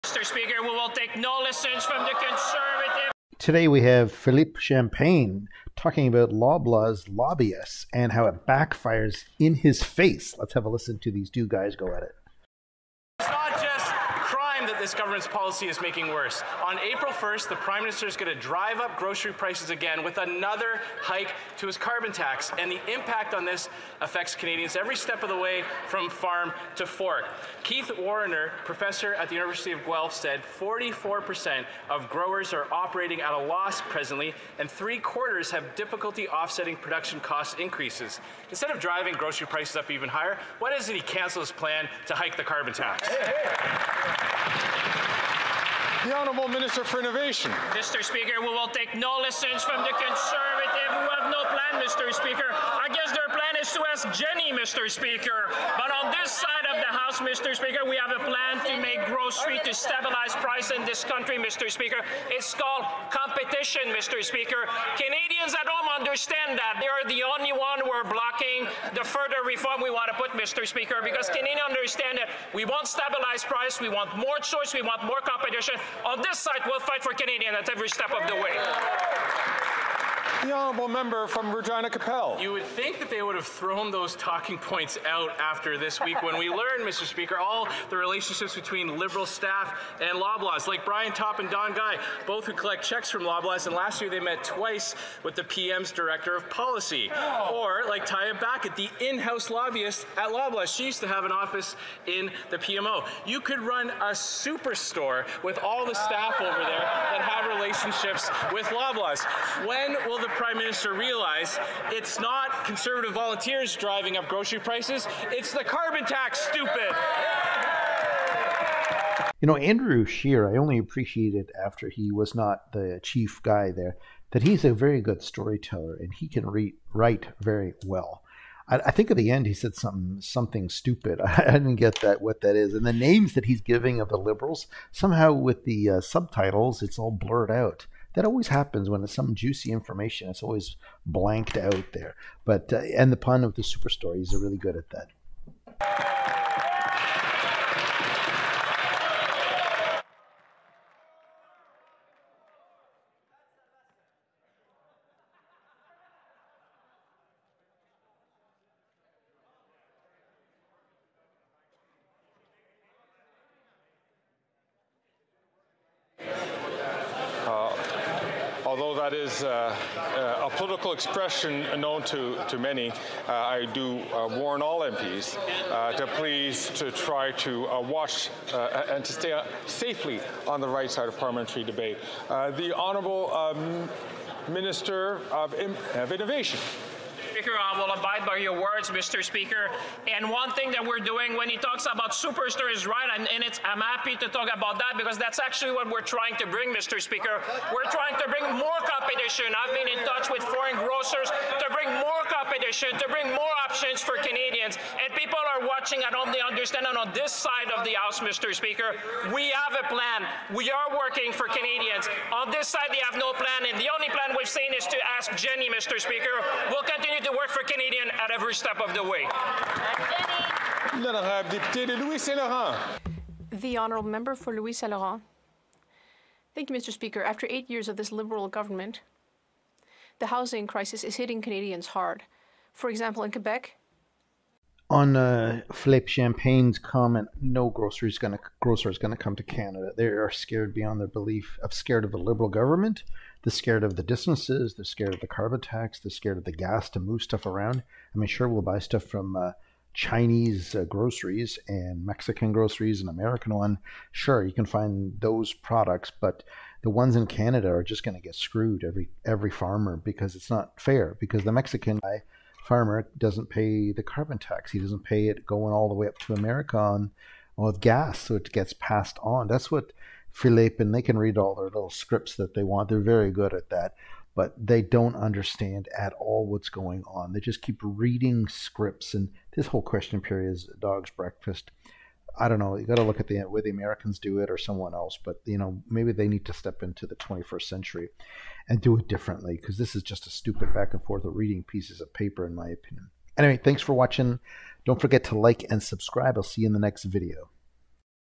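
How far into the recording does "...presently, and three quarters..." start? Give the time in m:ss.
0:33.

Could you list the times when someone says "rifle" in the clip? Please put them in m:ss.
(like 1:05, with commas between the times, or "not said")
not said.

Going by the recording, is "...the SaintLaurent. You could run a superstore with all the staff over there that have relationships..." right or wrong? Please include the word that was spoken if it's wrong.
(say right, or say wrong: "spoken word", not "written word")
wrong: "PMO", not "SaintLaurent".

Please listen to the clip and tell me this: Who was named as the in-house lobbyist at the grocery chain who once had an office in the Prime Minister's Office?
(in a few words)
Taya Backett.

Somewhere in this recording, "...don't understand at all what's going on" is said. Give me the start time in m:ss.
4:34.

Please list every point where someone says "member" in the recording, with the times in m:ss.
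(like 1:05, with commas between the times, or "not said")
1:20, 3:44.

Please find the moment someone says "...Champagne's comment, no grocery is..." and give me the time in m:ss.
3:56.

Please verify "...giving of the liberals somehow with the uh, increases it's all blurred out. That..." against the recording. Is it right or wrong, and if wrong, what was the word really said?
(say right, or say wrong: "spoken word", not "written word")
wrong: "subtitles", not "increases".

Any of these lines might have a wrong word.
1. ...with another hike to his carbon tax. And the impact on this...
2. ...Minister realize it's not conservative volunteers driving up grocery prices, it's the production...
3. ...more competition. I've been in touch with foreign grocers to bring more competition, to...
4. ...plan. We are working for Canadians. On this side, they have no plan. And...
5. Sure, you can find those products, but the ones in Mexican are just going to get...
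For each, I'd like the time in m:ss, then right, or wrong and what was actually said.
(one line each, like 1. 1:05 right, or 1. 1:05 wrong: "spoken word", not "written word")
1. 0:20 right
2. 1:50 wrong: "carbon", not "production"
3. 3:18 right
4. 3:29 right
5. 4:14 wrong: "Canada", not "Mexican".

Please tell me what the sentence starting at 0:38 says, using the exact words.
Instead of driving grocery prices up even higher, why doesn't he cancel his plan to hike the carbon tax?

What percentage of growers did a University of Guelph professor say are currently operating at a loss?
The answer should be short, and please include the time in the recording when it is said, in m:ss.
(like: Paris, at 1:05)
44%, at 0:30.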